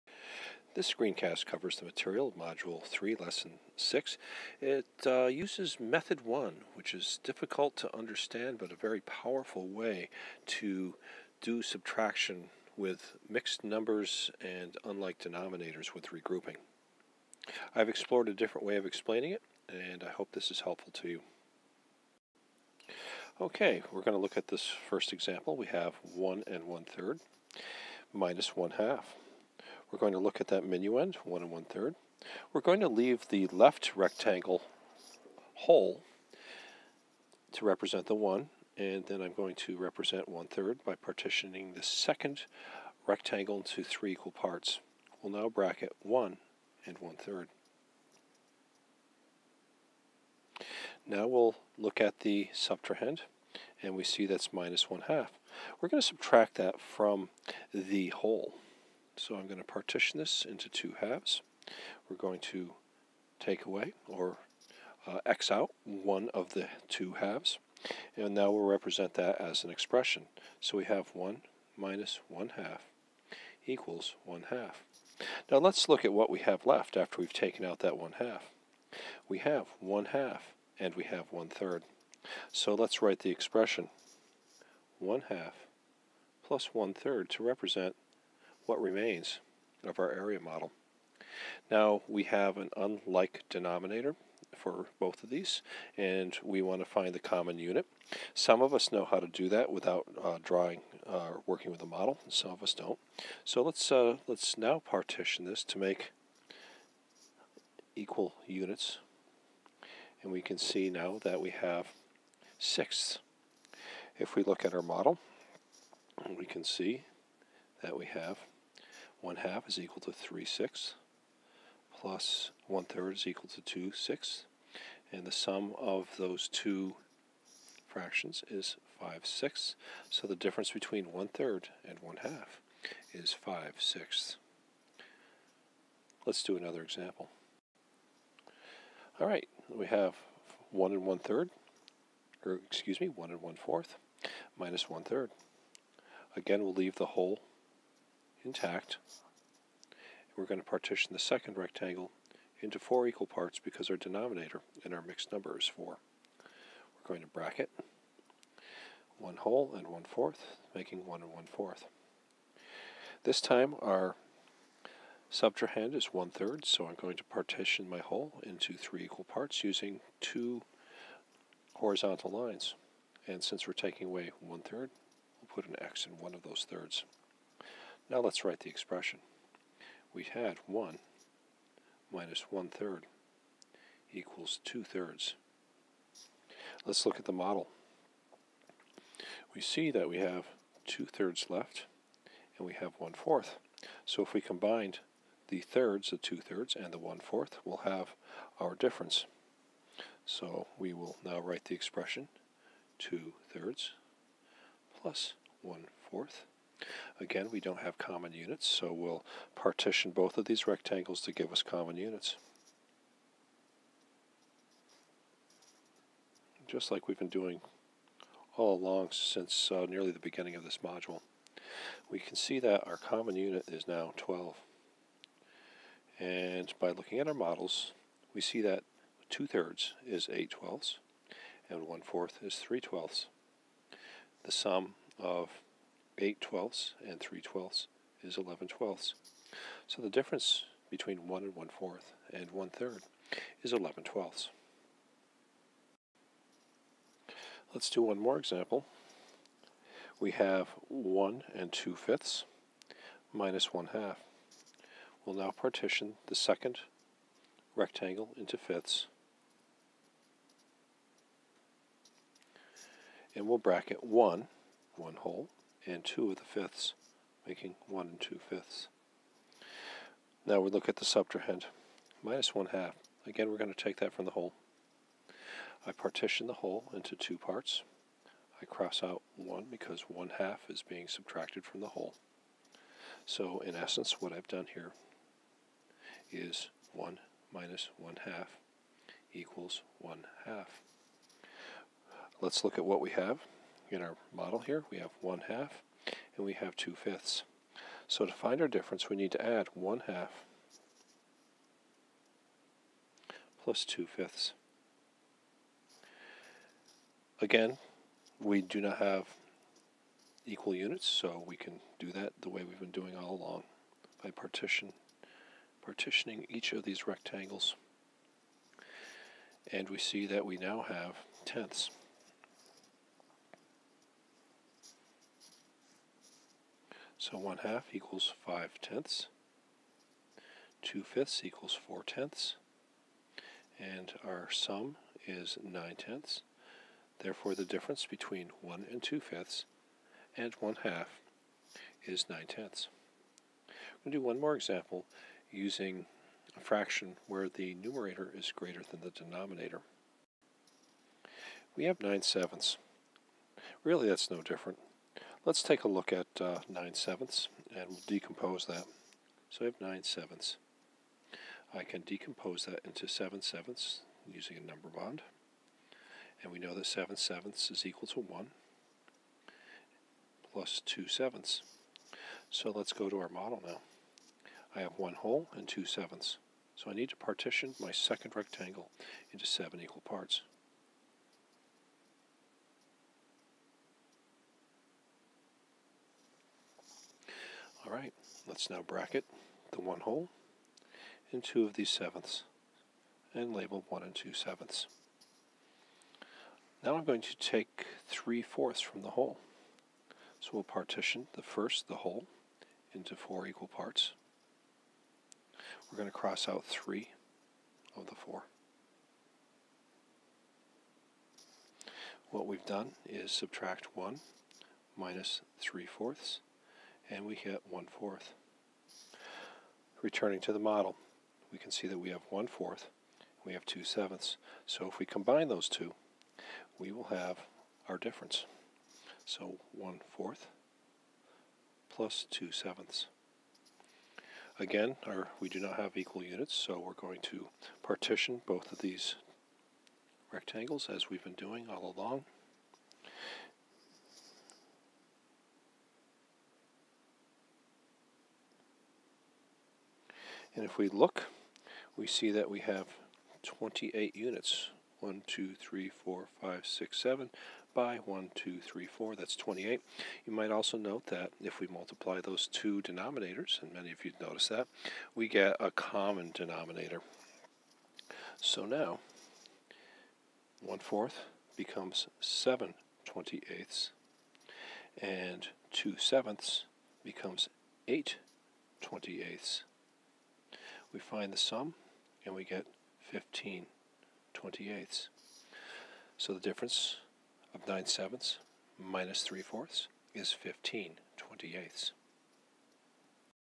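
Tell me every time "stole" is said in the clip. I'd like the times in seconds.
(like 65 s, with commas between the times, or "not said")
not said.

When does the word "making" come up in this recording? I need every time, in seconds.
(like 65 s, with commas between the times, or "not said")
160 s, 267 s.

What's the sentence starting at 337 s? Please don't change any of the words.
Therefore the difference between 1 and 2 fifths and 1 half is 9 tenths.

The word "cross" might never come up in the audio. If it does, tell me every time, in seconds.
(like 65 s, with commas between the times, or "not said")
278 s, 406 s.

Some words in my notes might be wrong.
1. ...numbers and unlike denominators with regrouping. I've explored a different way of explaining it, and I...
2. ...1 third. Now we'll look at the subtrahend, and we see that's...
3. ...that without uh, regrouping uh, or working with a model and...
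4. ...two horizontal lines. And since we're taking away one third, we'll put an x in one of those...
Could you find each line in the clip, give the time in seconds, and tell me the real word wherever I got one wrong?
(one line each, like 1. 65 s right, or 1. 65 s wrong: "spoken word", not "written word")
1. 13 s right
2. 46 s right
3. 99 s wrong: "drawing", not "regrouping"
4. 170 s right.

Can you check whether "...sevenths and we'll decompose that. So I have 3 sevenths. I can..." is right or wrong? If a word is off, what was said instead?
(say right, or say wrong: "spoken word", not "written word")
wrong: "9", not "3".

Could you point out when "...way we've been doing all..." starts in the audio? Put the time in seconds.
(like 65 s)
312 s.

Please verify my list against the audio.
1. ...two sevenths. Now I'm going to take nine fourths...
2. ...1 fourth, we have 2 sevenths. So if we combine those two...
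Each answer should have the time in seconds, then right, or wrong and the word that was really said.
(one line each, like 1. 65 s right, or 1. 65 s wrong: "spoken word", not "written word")
1. 394 s wrong: "three", not "nine"
2. 422 s right.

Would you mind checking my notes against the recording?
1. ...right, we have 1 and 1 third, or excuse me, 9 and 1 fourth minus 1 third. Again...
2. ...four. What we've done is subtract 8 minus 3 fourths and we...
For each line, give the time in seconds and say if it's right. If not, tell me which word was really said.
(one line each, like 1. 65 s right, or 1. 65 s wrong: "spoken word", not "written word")
1. 139 s wrong: "1", not "9"
2. 408 s wrong: "1", not "8".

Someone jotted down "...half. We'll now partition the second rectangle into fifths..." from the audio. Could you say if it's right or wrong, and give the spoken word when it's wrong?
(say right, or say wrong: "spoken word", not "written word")
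right.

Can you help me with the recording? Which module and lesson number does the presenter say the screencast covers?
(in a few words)
Module 3, Lesson 6.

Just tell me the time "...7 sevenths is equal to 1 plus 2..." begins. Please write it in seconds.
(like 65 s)
366 s.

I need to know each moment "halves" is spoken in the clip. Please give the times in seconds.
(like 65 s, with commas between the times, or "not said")
60 s, 67 s.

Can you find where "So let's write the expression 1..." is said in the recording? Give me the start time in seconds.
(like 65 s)
82 s.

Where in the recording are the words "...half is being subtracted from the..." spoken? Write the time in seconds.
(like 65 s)
280 s.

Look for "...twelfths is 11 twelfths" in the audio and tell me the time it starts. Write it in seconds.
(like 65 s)
237 s.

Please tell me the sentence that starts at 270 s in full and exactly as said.
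Now we look at the subtrahend, minus one half.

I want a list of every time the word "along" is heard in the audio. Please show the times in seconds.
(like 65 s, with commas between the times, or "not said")
218 s, 313 s, 441 s.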